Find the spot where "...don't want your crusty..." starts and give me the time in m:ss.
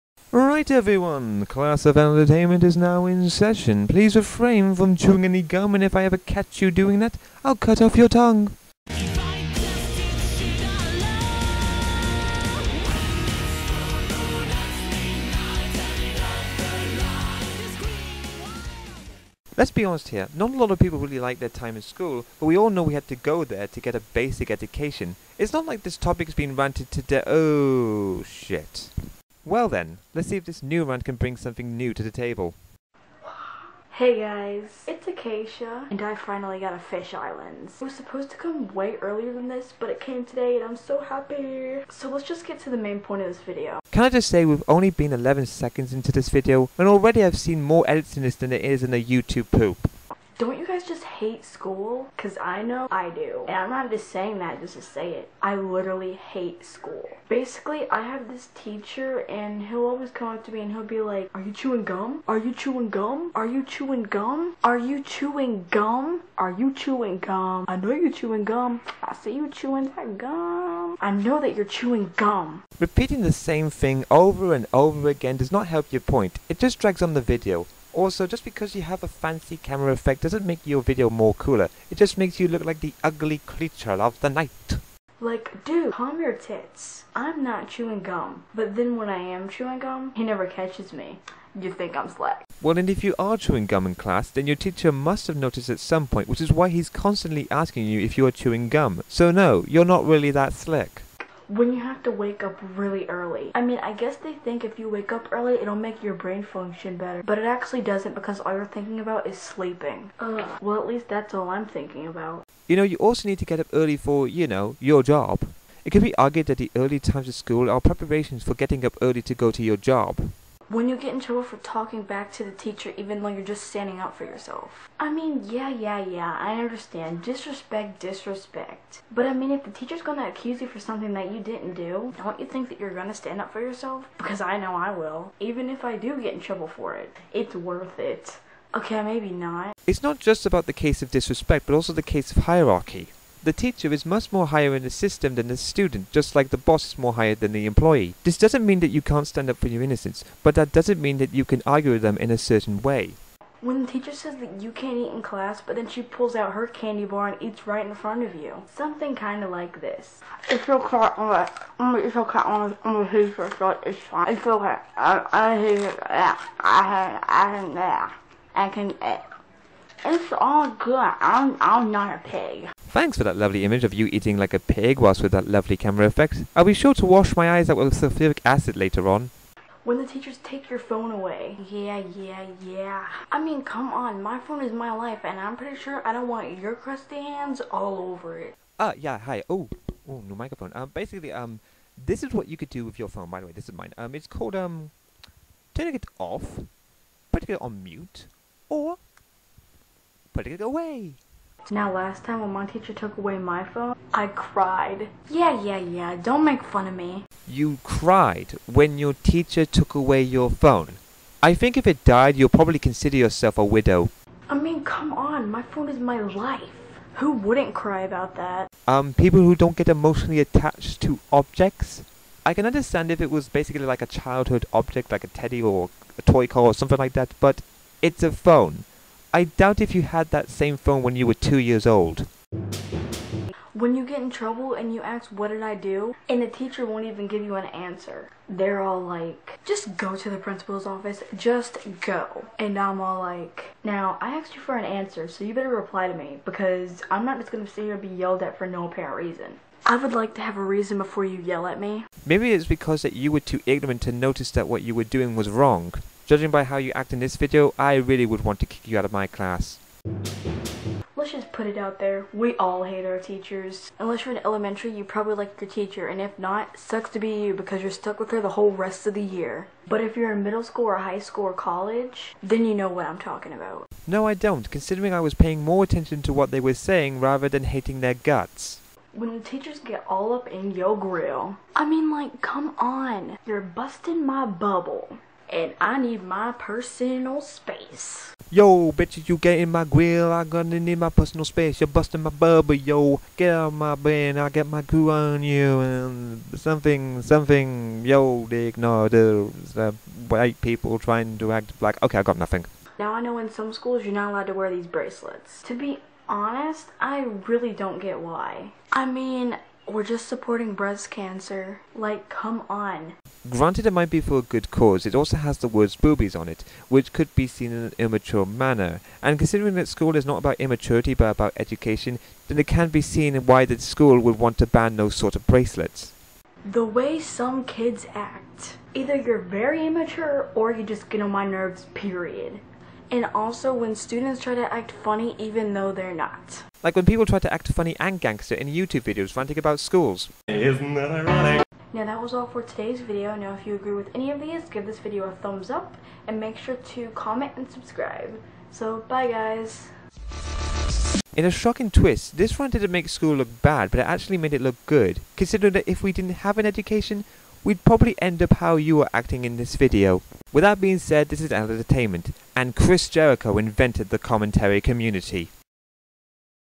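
3:06.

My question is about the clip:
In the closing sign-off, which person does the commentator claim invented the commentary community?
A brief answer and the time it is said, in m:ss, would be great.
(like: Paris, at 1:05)
Chris Jericho, at 6:02.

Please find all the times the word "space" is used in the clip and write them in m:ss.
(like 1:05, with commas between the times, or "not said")
4:47, 4:51.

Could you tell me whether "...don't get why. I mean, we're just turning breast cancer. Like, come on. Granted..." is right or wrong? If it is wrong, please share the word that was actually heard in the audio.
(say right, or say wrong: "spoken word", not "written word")
wrong: "supporting", not "turning".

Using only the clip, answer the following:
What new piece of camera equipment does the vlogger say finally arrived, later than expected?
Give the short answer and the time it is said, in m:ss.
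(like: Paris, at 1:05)
fisheye lens, at 0:36.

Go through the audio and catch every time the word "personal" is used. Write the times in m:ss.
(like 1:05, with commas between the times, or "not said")
4:46, 4:51.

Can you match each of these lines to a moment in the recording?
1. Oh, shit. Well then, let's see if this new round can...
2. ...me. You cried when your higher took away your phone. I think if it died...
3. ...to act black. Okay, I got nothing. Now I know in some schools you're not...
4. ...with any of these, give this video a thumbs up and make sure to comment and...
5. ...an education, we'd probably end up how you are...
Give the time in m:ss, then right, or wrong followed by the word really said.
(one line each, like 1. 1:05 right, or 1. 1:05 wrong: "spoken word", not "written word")
1. 0:27 right
2. 3:26 wrong: "teacher", not "higher"
3. 5:01 right
4. 5:43 right
5. 5:56 right.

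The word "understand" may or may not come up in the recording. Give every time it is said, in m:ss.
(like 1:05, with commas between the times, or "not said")
2:06, 3:42.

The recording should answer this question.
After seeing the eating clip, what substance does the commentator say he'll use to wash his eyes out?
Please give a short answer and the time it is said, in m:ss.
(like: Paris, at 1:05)
sulfuric acid, at 2:57.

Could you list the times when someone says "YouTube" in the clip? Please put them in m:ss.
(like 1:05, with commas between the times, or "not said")
0:49, 5:38.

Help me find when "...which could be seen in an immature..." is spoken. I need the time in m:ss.
5:16.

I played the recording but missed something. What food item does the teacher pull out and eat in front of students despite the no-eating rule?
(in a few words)
candy bar.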